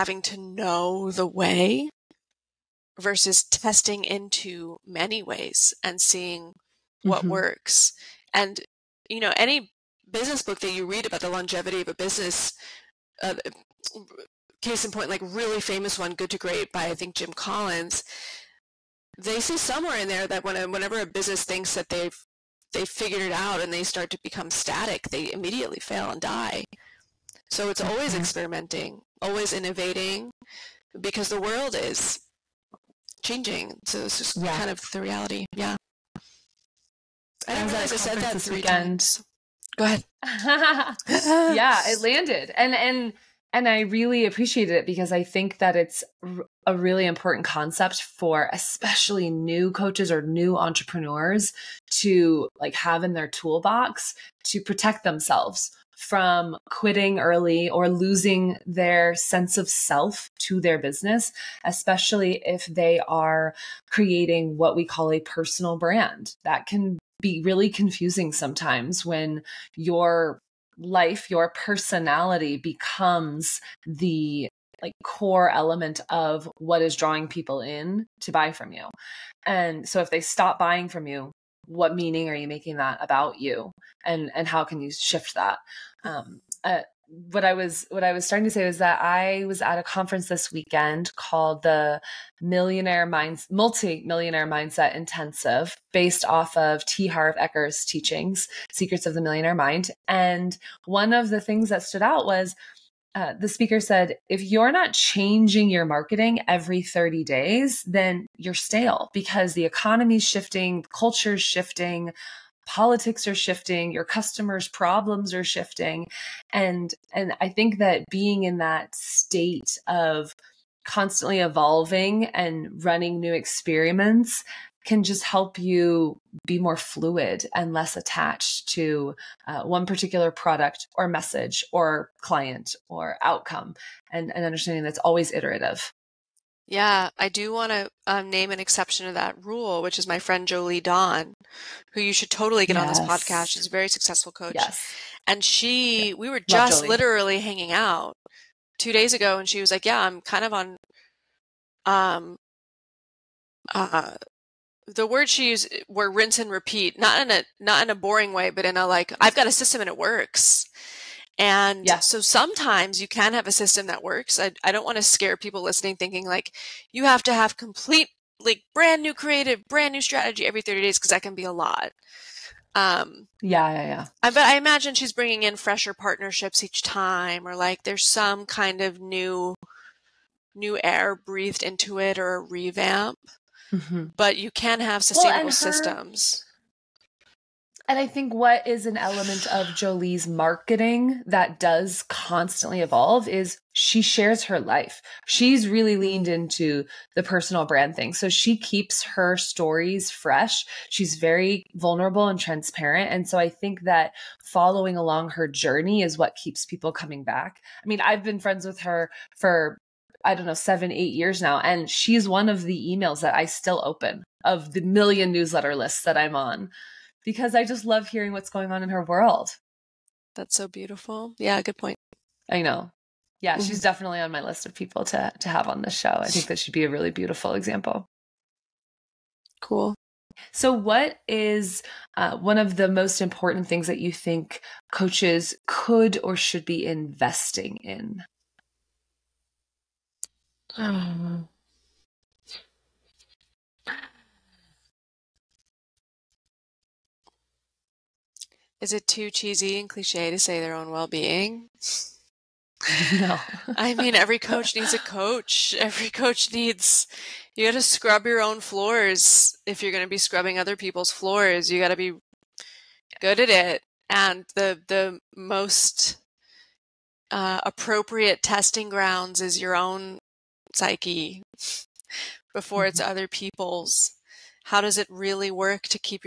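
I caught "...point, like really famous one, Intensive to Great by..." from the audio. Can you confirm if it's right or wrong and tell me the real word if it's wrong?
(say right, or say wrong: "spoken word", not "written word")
wrong: "Good", not "Intensive".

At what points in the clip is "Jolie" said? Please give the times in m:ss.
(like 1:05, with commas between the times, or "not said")
2:20, 3:09.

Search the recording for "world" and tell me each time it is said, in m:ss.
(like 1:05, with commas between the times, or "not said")
0:31, 3:39.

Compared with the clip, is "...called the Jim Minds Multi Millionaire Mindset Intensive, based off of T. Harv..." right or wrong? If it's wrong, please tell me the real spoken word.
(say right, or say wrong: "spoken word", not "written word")
wrong: "Millionaire", not "Jim".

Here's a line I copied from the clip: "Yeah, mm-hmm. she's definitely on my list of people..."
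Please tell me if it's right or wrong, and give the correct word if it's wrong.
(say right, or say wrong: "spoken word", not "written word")
right.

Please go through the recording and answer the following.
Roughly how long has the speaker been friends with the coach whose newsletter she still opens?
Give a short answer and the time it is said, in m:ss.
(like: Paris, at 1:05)
7 or 8 years, at 3:30.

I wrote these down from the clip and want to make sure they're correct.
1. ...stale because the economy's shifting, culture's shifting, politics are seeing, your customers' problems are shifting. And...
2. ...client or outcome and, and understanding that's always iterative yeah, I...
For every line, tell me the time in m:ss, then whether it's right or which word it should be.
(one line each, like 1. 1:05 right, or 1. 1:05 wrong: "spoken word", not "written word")
1. 1:48 wrong: "shifting", not "seeing"
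2. 2:12 right.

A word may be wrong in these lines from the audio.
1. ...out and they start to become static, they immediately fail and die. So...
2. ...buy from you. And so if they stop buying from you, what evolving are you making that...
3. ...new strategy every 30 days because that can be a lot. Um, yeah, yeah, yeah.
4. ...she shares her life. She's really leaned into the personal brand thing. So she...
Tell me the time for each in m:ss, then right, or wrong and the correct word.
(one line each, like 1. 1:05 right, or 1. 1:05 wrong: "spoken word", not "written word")
1. 0:23 right
2. 1:18 wrong: "meaning", not "evolving"
3. 2:49 right
4. 3:13 right.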